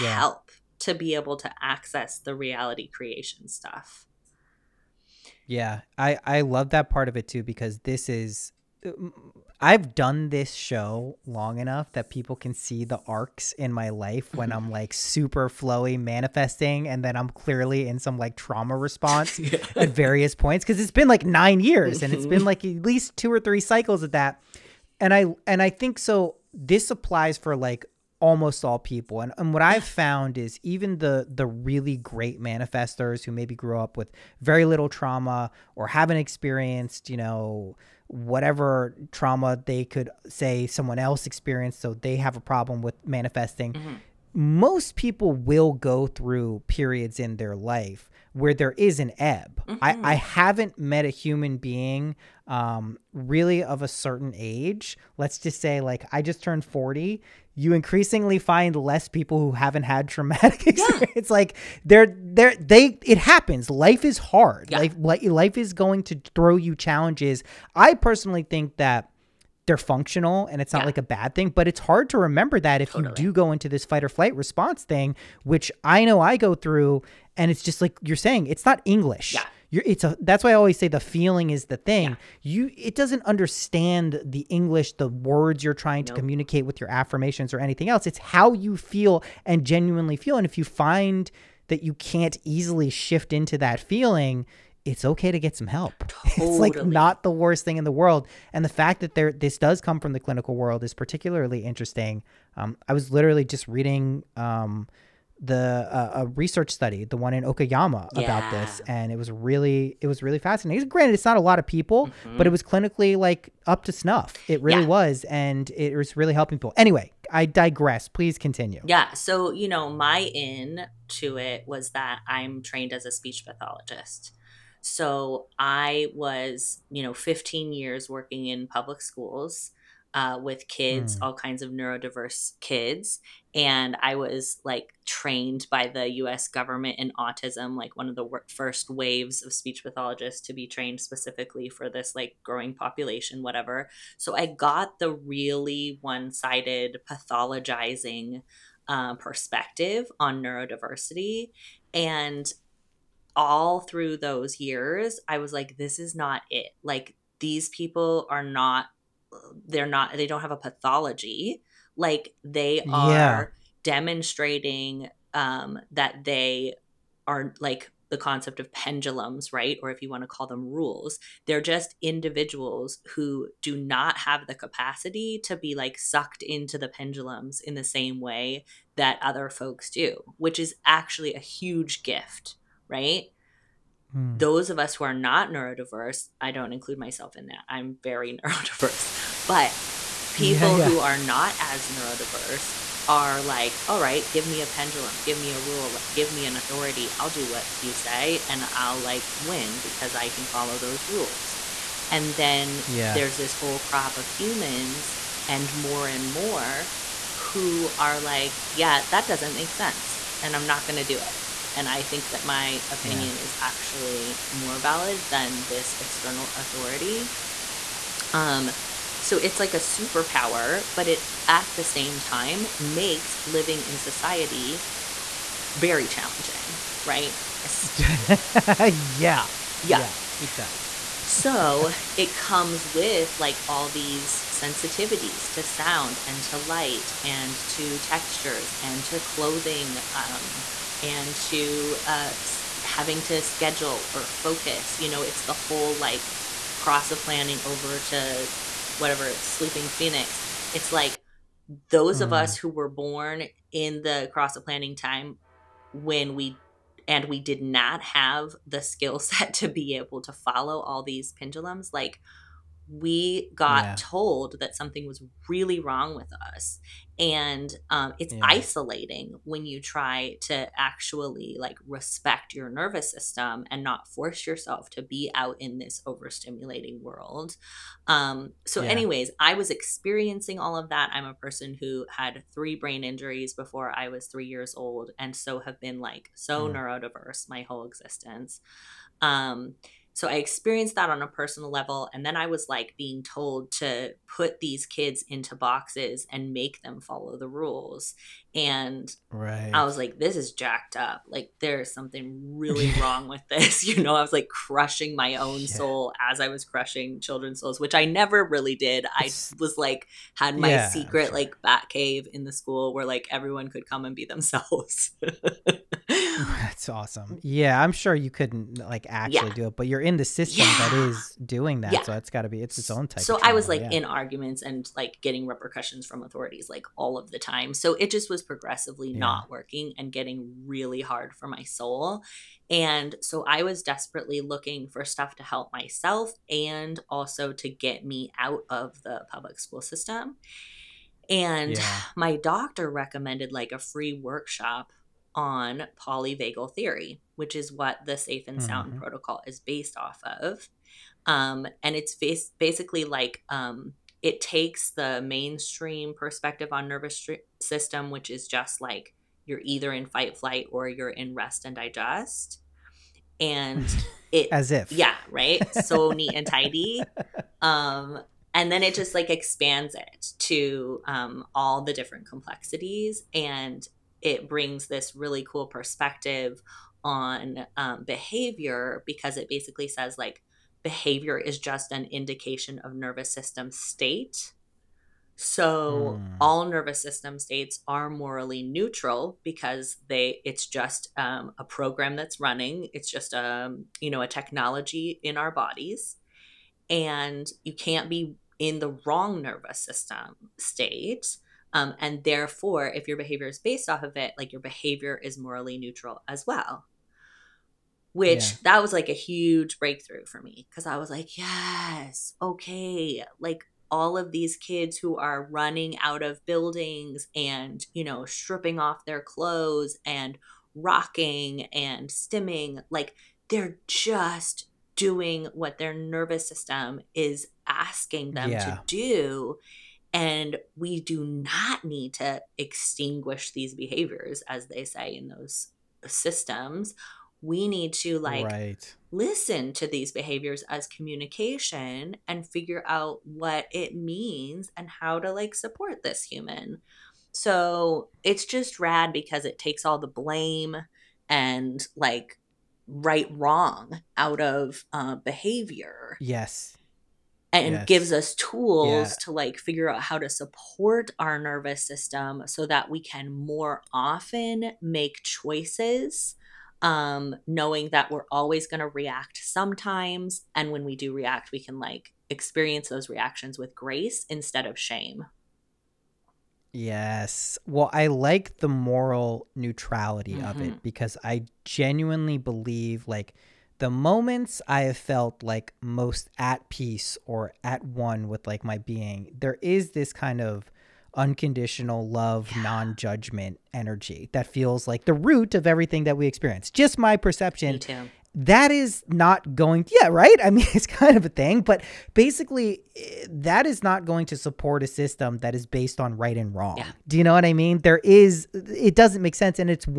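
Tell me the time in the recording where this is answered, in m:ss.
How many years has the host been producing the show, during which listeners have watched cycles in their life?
0:21.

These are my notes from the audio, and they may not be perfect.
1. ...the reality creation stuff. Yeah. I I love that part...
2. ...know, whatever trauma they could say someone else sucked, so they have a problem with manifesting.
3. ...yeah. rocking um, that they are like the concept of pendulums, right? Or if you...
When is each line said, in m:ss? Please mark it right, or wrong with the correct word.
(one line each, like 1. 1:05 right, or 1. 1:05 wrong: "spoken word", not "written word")
1. 0:02 right
2. 0:37 wrong: "experienced", not "sucked"
3. 2:43 wrong: "demonstrating", not "rocking".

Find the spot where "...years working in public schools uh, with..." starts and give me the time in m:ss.
2:07.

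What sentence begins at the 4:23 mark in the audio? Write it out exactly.
told that something was really wrong with us and um, it's yeah.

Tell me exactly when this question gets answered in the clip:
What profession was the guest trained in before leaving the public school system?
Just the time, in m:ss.
2:03.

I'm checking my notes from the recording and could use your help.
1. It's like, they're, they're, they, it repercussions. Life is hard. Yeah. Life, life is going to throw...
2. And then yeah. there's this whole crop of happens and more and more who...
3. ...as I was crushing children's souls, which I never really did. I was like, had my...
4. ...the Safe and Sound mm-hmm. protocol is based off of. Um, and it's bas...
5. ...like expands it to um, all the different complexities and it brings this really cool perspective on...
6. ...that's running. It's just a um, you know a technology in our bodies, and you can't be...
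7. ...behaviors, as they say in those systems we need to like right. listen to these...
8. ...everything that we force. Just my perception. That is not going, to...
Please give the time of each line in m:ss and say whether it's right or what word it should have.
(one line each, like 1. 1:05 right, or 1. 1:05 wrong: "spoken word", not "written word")
1. 1:01 wrong: "happens", not "repercussions"
2. 3:22 wrong: "humans", not "happens"
3. 5:06 right
4. 5:48 right
5. 6:09 right
6. 6:32 right
7. 7:13 right
8. 8:15 wrong: "experience", not "force".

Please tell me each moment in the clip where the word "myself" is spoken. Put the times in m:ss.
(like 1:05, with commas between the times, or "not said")
3:06, 5:35.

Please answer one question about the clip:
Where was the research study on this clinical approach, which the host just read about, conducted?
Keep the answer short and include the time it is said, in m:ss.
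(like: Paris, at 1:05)
Okayama, at 1:47.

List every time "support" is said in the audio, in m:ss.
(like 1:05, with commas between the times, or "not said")
7:25, 7:40, 8:24.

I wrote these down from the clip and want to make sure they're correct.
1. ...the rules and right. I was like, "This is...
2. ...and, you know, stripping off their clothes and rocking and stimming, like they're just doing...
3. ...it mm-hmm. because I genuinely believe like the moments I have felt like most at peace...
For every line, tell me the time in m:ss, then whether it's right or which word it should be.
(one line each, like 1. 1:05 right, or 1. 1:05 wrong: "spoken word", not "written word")
1. 4:57 right
2. 6:57 right
3. 8:00 right.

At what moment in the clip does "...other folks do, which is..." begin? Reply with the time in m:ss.
2:59.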